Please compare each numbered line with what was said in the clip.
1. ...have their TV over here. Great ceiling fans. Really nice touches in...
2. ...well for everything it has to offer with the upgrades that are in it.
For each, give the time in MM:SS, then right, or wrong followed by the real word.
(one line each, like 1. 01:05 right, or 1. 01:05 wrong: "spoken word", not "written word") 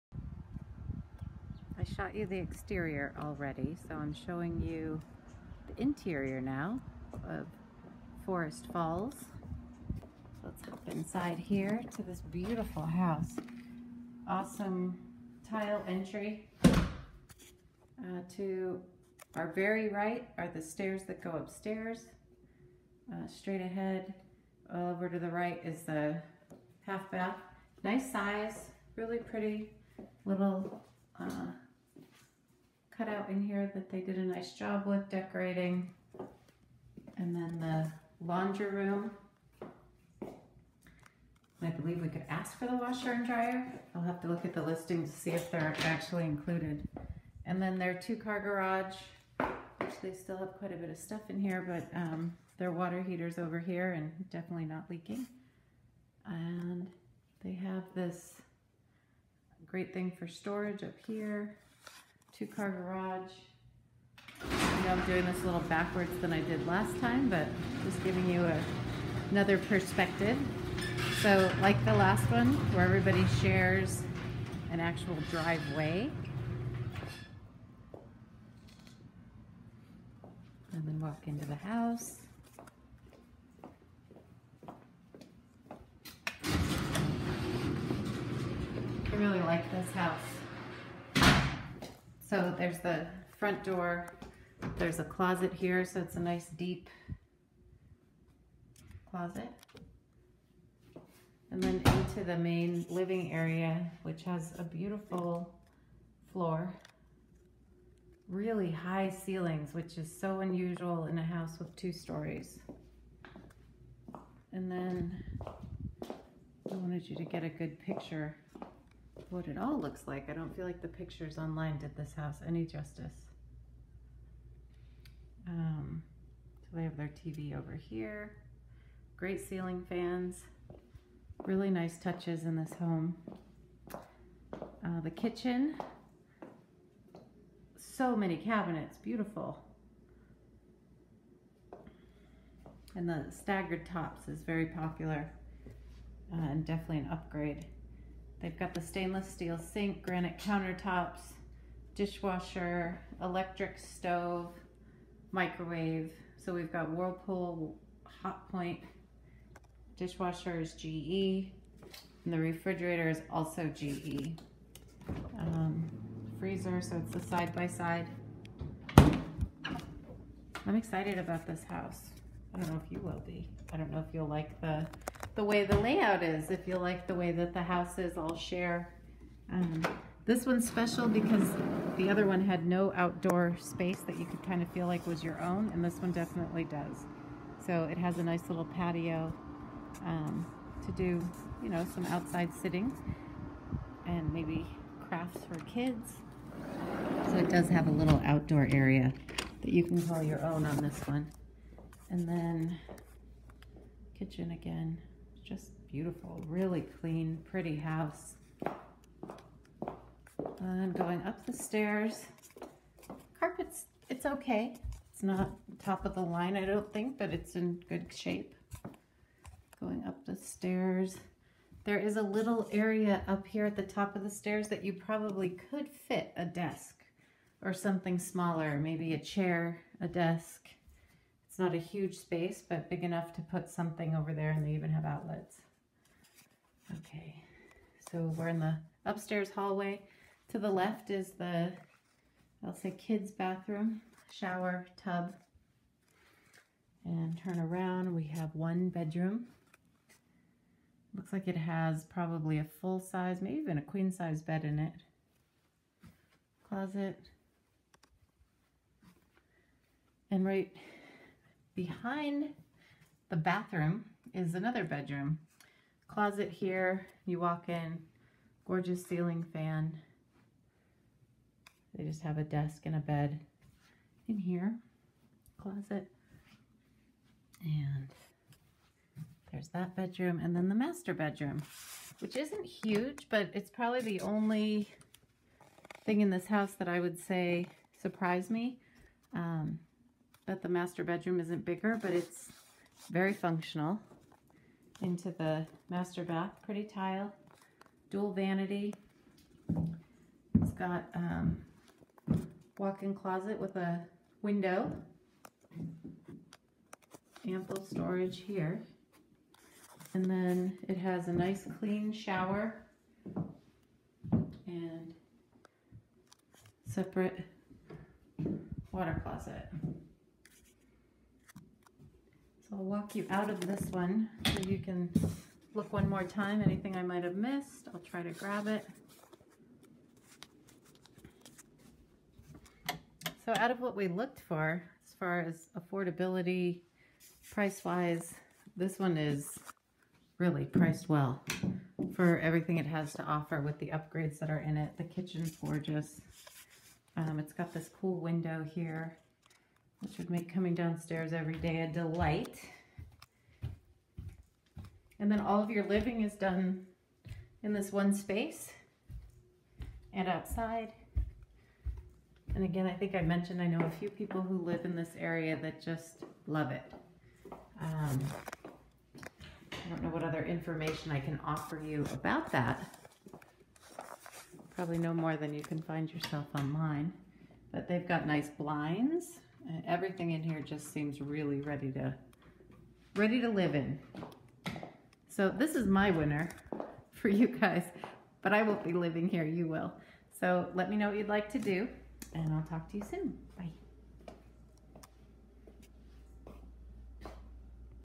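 1. 02:06 right
2. 05:41 right.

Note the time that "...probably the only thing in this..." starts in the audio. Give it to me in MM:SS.
04:43.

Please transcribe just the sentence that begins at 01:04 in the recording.
I know I'm doing this a little backwards than I did last time, but just giving you a, another perspective.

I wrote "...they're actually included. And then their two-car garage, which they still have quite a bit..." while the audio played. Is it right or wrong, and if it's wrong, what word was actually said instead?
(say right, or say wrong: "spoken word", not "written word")
right.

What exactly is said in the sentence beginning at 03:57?
Okay, so we're in the upstairs hallway.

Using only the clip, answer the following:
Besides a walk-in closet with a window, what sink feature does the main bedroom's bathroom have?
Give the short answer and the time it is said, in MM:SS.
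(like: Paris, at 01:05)
Dual vanity, at 04:58.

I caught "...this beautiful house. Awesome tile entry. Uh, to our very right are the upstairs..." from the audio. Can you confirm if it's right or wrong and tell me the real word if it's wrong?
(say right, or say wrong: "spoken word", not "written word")
wrong: "stairs", not "upstairs".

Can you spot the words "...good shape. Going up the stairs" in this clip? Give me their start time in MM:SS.
03:37.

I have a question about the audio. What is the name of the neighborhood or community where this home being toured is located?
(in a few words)
Forest Falls.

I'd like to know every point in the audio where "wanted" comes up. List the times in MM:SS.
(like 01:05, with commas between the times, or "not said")
01:56.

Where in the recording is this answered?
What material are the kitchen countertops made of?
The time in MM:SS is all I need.
02:30.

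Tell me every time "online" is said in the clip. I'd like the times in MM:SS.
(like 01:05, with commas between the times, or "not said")
02:01, 06:16.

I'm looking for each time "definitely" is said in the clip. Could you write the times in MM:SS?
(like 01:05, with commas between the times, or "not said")
00:54, 02:26, 03:06.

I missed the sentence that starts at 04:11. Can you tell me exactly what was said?
Looks like it has probably a full size, maybe even a queen size bed in it.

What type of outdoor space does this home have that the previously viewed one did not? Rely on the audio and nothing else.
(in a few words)
Patio.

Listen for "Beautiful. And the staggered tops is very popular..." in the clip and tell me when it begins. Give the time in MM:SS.
02:18.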